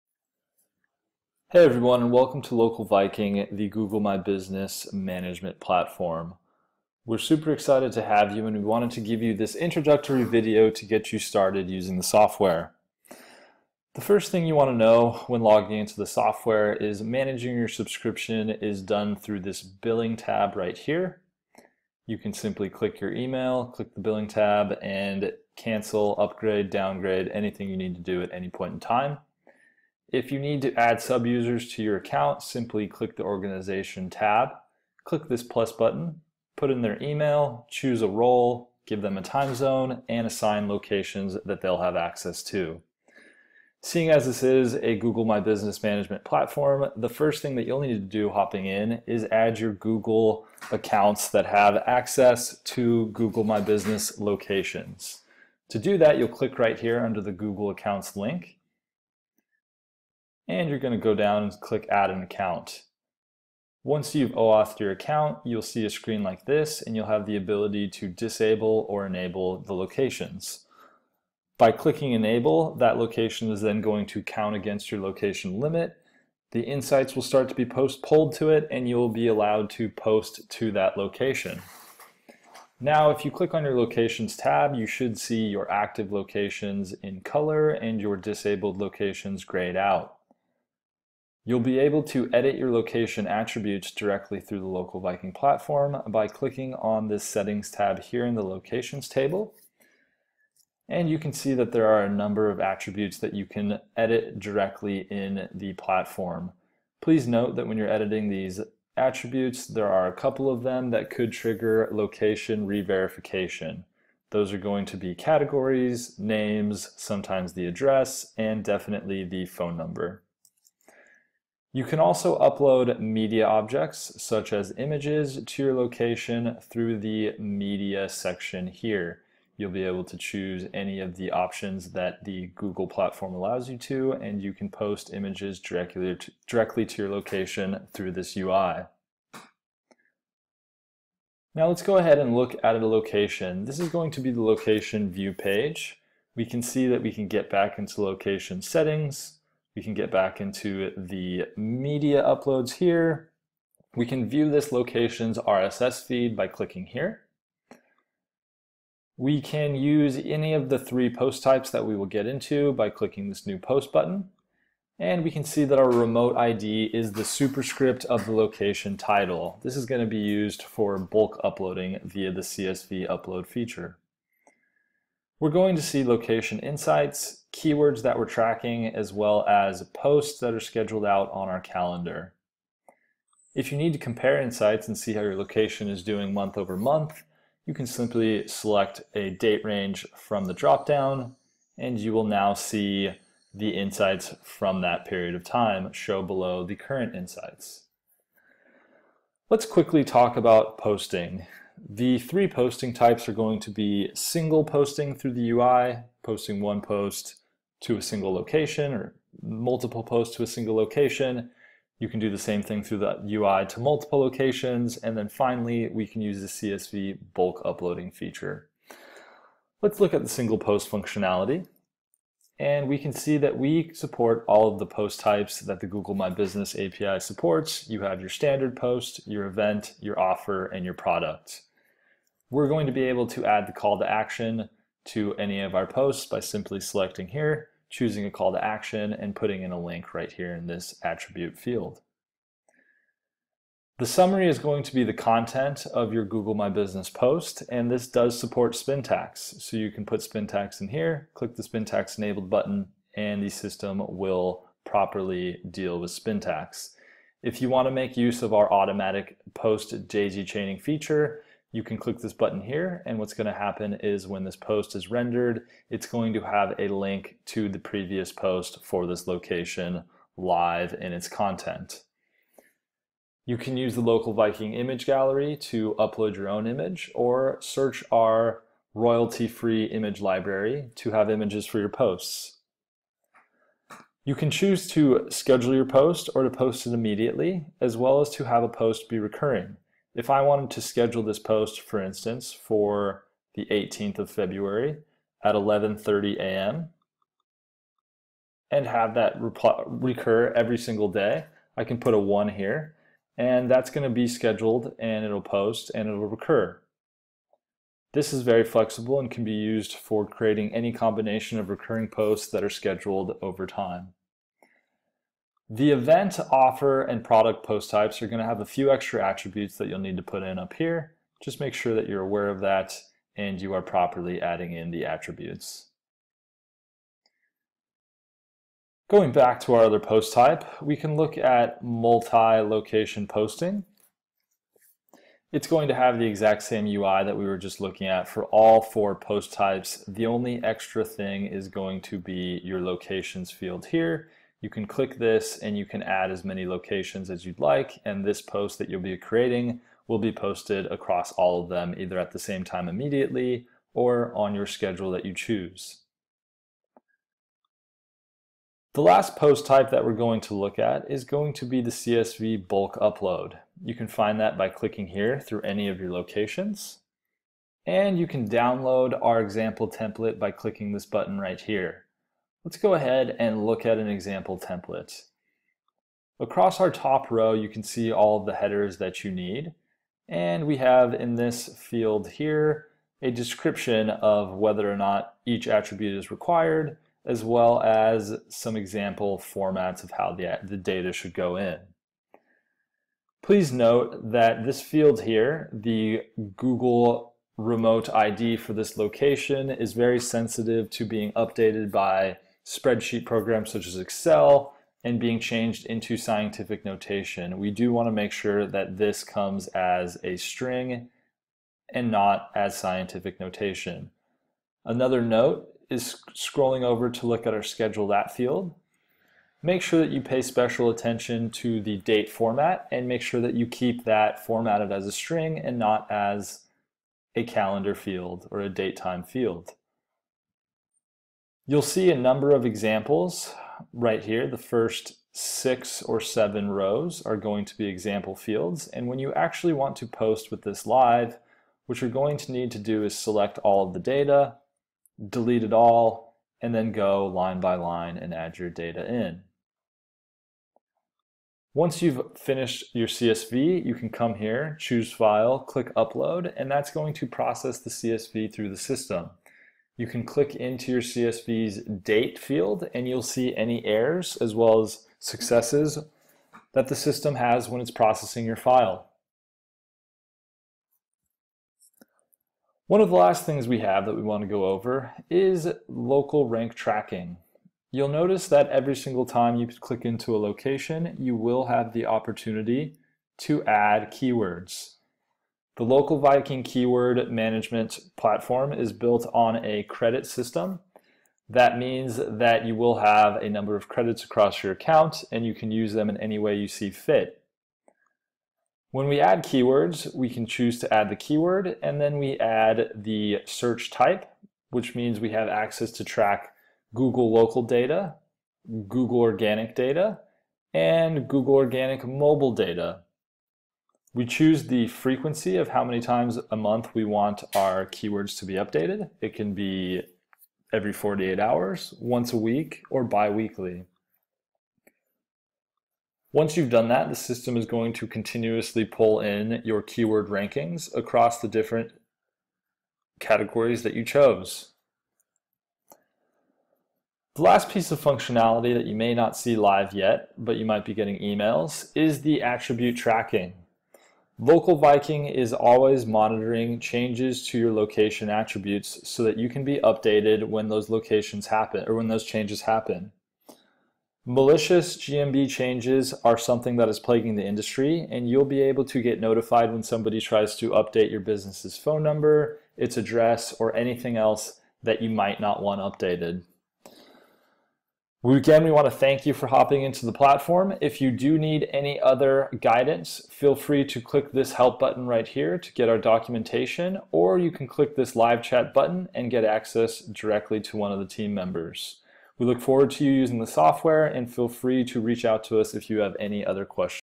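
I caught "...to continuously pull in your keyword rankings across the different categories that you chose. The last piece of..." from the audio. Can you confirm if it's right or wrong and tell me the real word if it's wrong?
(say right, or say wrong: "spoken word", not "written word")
right.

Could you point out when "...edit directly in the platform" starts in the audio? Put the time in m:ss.
1:43.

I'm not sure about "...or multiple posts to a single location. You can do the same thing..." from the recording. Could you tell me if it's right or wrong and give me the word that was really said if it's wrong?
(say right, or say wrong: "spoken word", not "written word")
right.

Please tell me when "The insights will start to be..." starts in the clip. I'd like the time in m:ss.
1:16.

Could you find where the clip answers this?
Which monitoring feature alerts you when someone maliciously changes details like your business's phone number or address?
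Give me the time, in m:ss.
9:02.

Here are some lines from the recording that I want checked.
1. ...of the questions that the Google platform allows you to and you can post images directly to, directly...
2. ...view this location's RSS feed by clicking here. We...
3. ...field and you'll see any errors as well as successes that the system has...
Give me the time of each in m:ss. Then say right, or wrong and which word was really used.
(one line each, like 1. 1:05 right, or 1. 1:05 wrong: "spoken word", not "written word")
1. 2:10 wrong: "options", not "questions"
2. 2:34 right
3. 7:42 right.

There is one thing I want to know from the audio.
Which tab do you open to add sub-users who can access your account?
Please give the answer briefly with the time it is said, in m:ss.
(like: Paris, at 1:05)
Organization, at 0:33.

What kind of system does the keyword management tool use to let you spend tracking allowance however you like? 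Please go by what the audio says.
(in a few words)
Credit system.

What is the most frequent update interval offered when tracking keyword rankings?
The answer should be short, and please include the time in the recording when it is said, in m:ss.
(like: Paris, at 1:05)
Every 48 hours, at 8:40.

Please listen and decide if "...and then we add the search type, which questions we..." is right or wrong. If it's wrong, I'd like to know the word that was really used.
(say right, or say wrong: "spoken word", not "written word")
wrong: "means", not "questions".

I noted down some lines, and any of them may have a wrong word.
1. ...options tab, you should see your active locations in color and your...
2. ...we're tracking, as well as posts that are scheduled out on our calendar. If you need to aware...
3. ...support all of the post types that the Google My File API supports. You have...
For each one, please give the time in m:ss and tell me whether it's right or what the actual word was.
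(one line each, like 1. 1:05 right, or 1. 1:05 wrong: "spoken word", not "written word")
1. 1:23 wrong: "locations", not "options"
2. 2:58 wrong: "compare", not "aware"
3. 3:43 wrong: "Business", not "File".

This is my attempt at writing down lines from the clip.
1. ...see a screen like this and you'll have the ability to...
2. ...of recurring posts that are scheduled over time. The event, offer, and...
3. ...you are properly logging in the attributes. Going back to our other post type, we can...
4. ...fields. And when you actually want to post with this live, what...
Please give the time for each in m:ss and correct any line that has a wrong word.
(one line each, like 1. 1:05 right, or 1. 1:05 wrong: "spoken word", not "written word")
1. 1:05 right
2. 5:11 right
3. 5:23 wrong: "adding", not "logging"
4. 7:18 right.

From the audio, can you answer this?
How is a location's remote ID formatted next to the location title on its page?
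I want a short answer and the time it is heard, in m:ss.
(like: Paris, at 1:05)
Superscript, at 2:47.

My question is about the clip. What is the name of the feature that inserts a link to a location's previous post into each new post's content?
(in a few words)
Daisy chaining.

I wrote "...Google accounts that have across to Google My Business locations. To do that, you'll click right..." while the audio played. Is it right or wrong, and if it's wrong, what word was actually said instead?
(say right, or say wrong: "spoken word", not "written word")
wrong: "access", not "across".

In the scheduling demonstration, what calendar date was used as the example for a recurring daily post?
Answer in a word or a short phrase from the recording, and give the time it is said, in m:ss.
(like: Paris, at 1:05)
18th of February, at 4:53.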